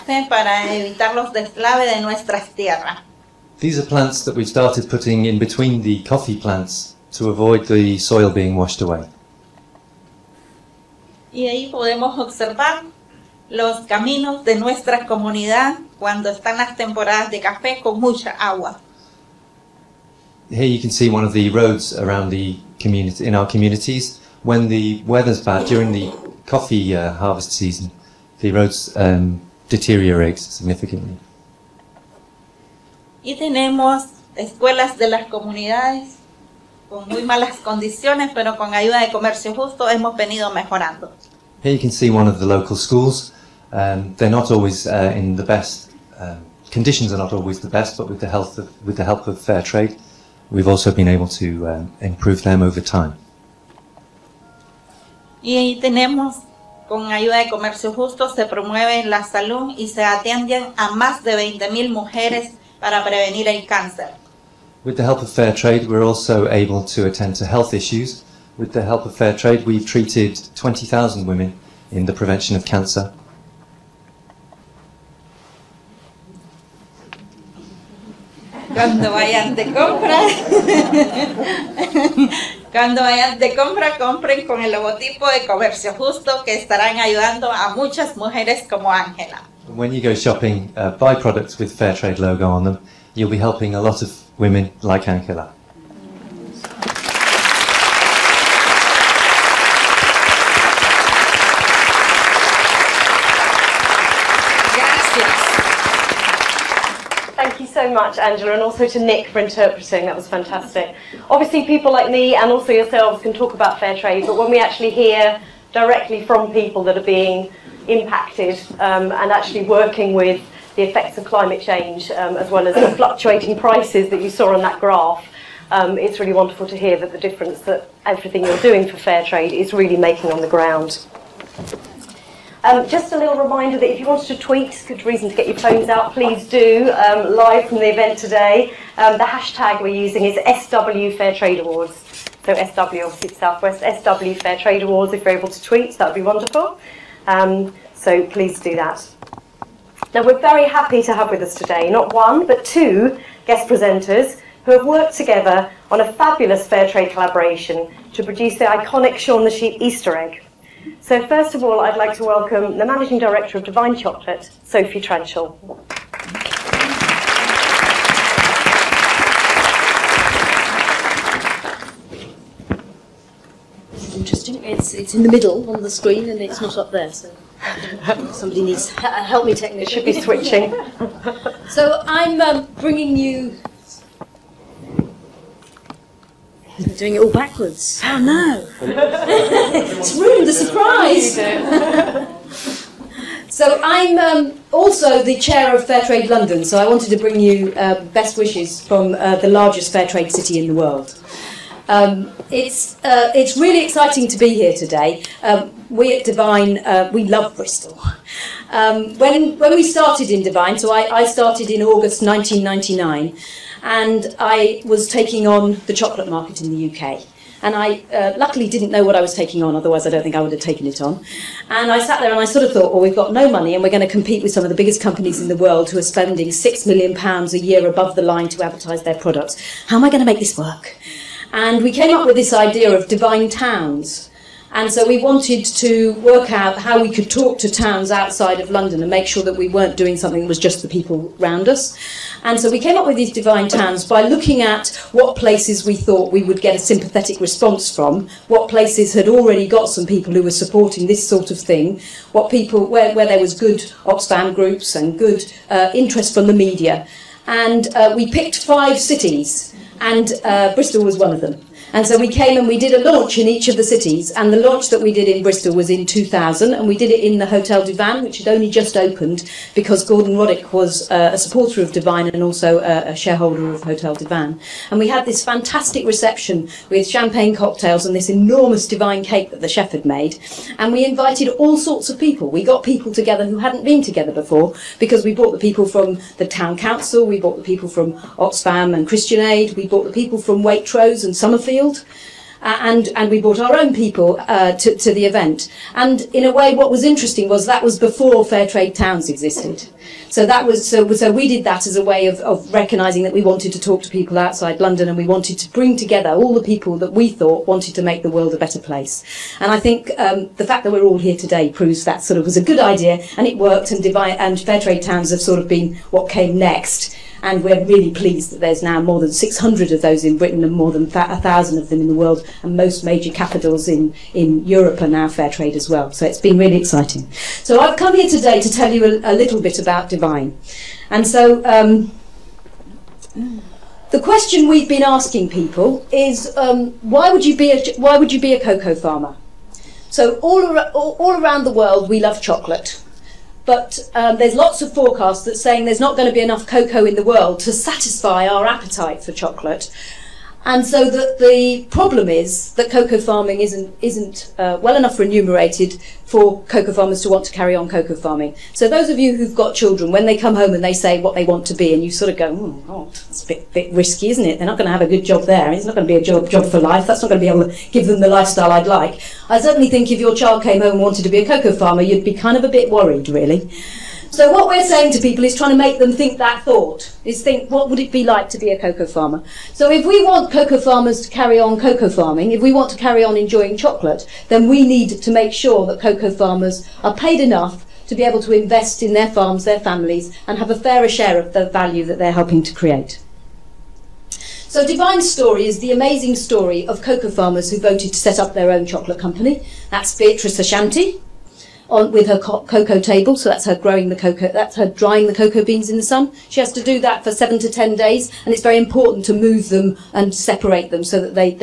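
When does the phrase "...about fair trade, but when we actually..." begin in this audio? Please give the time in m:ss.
1:53.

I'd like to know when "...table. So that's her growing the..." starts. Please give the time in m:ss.
6:42.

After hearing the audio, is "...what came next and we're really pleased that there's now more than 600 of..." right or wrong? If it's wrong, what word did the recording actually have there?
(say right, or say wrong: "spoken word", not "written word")
right.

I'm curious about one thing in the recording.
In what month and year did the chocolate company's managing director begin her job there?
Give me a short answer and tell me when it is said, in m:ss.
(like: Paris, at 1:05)
August 1999, at 3:31.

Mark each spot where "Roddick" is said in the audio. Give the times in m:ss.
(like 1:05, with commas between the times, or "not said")
4:30.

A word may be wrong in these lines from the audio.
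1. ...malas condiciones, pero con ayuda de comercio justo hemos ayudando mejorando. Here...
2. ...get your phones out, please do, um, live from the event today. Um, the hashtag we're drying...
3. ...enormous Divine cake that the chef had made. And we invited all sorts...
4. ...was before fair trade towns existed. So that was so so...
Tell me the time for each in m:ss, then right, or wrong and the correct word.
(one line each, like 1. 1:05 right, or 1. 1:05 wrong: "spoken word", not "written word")
1. 0:37 wrong: "venido", not "ayudando"
2. 2:15 wrong: "using", not "drying"
3. 4:38 right
4. 4:57 right.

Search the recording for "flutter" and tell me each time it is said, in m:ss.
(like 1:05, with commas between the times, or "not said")
not said.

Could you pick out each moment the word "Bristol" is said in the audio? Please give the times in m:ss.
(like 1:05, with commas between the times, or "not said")
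3:27, 4:20, 4:25.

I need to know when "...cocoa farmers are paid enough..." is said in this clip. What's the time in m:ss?
6:26.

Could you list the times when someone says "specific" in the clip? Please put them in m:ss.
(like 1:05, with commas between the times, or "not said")
not said.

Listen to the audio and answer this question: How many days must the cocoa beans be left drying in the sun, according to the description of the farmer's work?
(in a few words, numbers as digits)
7 to 10 days.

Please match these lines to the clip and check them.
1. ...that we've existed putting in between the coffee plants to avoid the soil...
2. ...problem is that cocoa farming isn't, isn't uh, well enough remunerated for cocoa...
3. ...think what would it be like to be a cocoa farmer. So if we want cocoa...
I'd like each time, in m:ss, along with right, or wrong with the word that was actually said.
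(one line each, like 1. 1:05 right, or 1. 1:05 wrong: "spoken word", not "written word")
1. 0:04 wrong: "started", not "existed"
2. 5:51 right
3. 6:17 right.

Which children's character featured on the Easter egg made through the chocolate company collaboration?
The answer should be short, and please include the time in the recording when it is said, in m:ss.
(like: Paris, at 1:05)
Shaun the Sheep, at 2:39.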